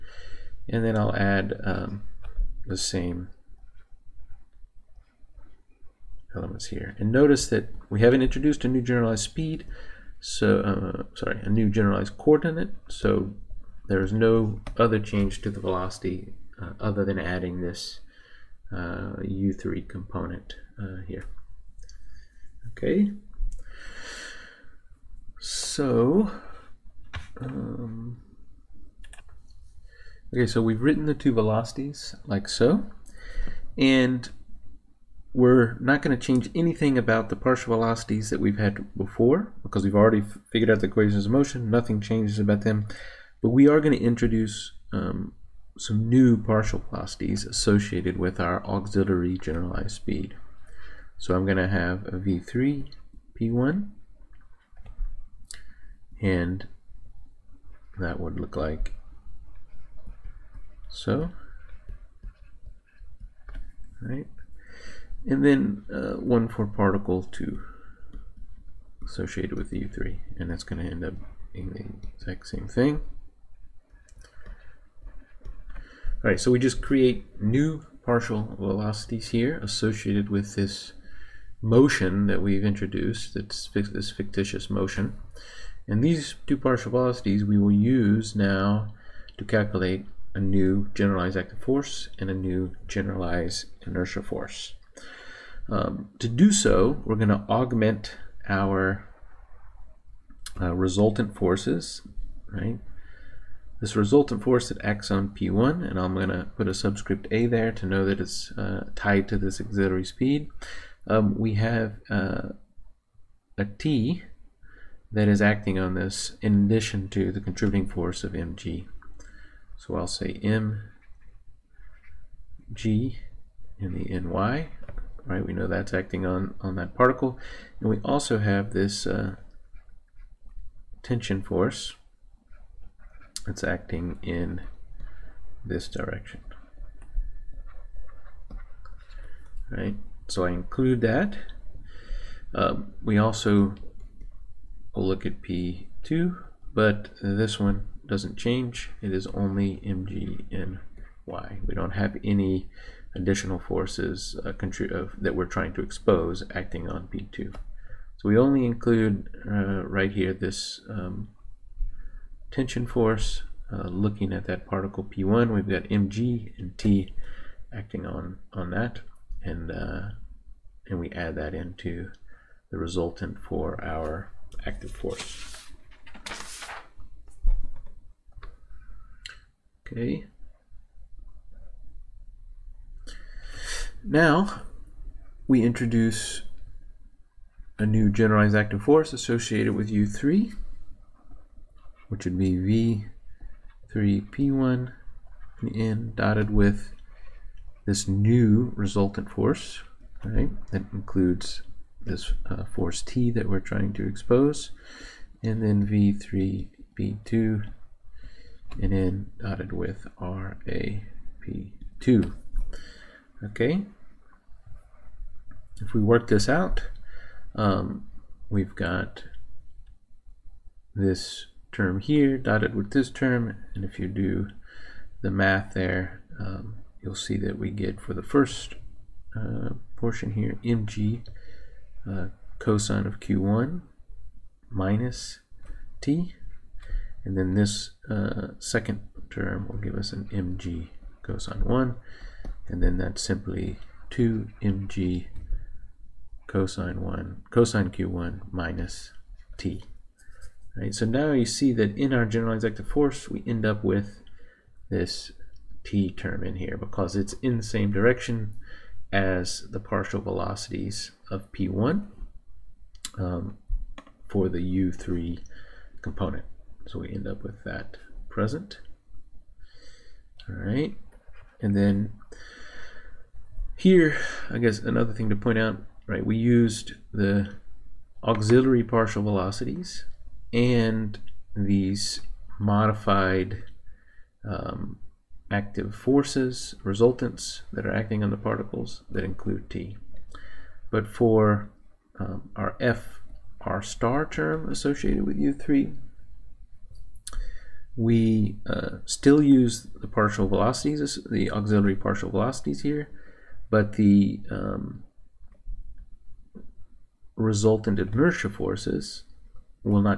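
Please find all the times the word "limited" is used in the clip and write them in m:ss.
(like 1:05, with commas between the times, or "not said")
not said.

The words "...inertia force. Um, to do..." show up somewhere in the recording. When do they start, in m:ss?
1:33.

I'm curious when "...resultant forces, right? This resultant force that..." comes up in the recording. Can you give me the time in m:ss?
1:40.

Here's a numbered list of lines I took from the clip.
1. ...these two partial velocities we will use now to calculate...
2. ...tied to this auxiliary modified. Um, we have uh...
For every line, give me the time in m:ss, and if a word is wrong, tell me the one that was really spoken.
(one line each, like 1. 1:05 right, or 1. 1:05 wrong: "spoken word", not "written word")
1. 1:26 right
2. 1:48 wrong: "speed", not "modified".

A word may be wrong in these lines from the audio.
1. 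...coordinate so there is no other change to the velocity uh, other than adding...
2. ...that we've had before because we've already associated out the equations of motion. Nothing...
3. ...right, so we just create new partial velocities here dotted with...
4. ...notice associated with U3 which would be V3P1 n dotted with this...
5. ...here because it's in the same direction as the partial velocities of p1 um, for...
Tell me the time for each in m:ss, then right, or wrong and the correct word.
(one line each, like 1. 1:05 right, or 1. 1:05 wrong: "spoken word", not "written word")
1. 0:12 right
2. 0:38 wrong: "figured", not "associated"
3. 1:16 wrong: "associated", not "dotted"
4. 3:08 wrong: "force", not "notice"
5. 4:16 right.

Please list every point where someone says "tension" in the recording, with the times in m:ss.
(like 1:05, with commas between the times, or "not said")
2:11, 2:42.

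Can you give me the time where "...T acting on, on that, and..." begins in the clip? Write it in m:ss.
2:46.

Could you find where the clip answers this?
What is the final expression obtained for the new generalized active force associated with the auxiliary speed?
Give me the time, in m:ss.
4:04.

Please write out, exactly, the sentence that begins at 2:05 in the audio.
We know that's acting on, on that particle.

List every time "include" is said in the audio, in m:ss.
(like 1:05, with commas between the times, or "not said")
2:20, 2:38, 3:20, 4:49.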